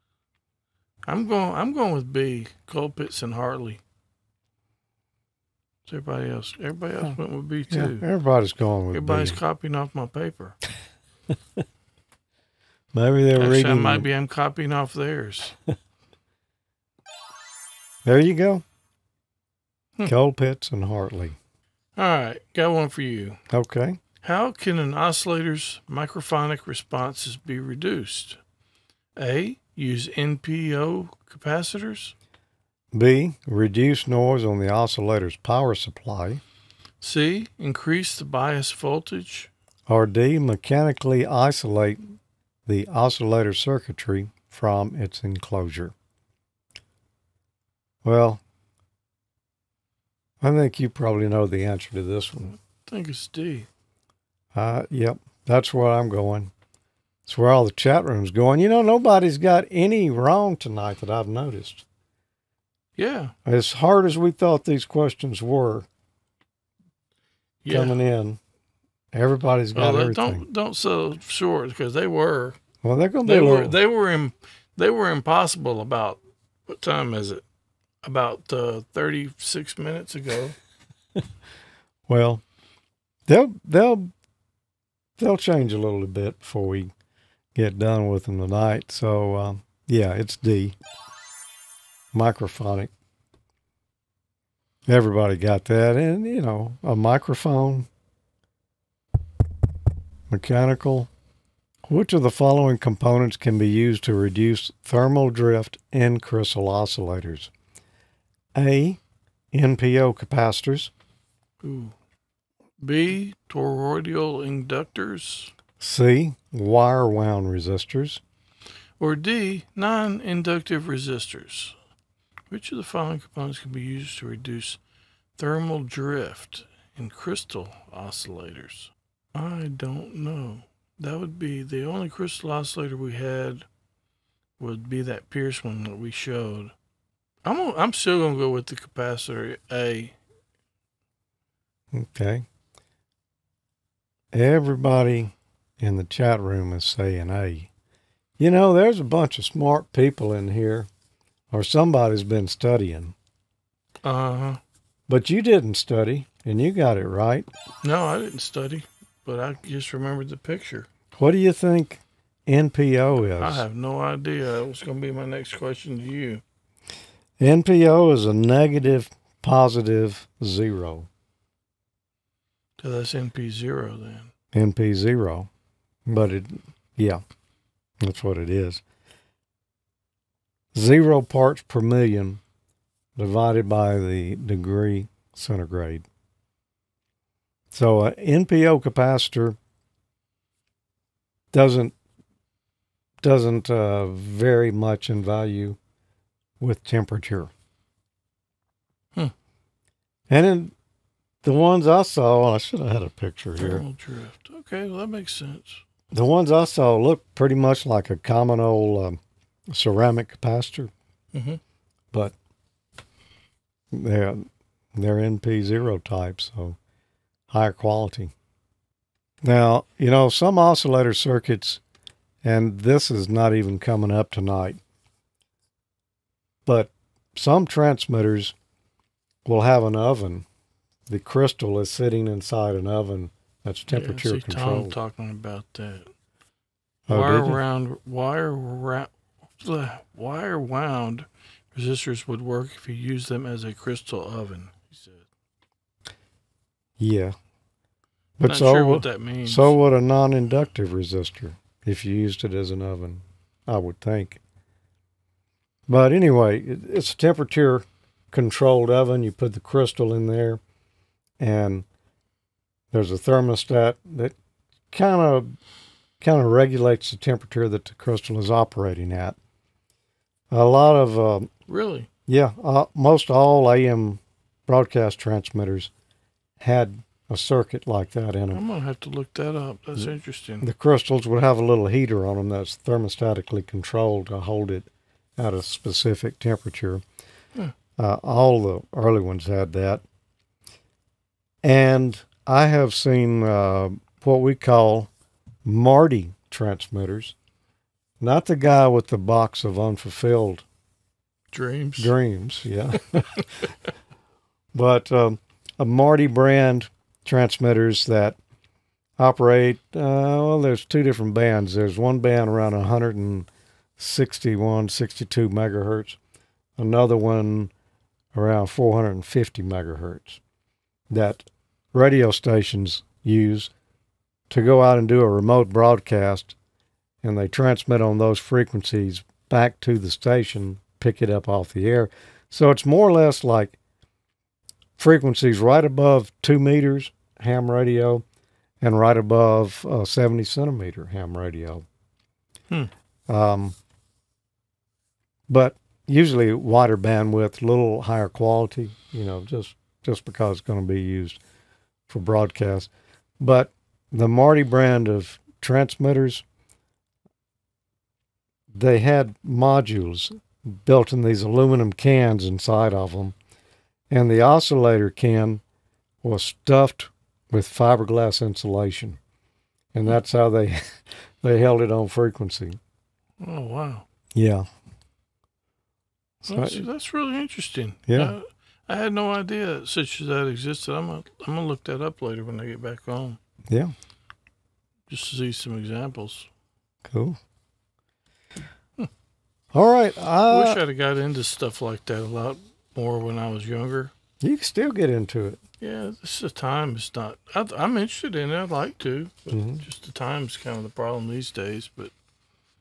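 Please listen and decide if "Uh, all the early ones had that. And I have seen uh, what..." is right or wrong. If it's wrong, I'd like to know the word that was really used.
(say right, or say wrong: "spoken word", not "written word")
right.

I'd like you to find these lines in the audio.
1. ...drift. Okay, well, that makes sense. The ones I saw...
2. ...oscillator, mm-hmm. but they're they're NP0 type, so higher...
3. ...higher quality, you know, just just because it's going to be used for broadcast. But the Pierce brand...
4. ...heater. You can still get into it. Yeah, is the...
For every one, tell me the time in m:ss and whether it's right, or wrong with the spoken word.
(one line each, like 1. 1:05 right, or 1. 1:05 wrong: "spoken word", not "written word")
1. 3:23 right
2. 3:30 wrong: "capacitor", not "oscillator"
3. 5:48 wrong: "Marti", not "Pierce"
4. 6:33 wrong: "younger", not "heater".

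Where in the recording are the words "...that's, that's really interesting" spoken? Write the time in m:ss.
6:16.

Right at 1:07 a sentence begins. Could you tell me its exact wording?
coming in, everybody's got well, everything.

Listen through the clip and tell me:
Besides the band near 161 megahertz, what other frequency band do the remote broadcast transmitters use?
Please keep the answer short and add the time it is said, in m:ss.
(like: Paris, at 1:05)
450 megahertz, at 5:18.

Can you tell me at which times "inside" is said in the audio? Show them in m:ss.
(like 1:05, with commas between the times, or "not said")
3:52, 6:02.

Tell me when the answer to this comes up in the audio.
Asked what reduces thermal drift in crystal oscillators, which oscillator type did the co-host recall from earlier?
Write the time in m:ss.
2:15.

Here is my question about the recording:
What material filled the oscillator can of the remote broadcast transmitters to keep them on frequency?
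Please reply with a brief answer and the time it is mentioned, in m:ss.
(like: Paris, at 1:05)
fiberglass insulation, at 6:07.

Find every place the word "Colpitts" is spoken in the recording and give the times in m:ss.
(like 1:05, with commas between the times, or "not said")
0:02, 0:20.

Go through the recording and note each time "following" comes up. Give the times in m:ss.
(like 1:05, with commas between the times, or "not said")
1:42, 2:02.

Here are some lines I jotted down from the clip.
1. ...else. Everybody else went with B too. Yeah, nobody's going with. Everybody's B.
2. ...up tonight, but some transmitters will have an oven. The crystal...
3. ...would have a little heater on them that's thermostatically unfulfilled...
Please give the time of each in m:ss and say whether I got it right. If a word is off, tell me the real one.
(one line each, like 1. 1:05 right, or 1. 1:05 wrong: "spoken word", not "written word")
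1. 0:06 wrong: "everybody", not "nobody"
2. 3:44 right
3. 4:41 wrong: "controlled", not "unfulfilled".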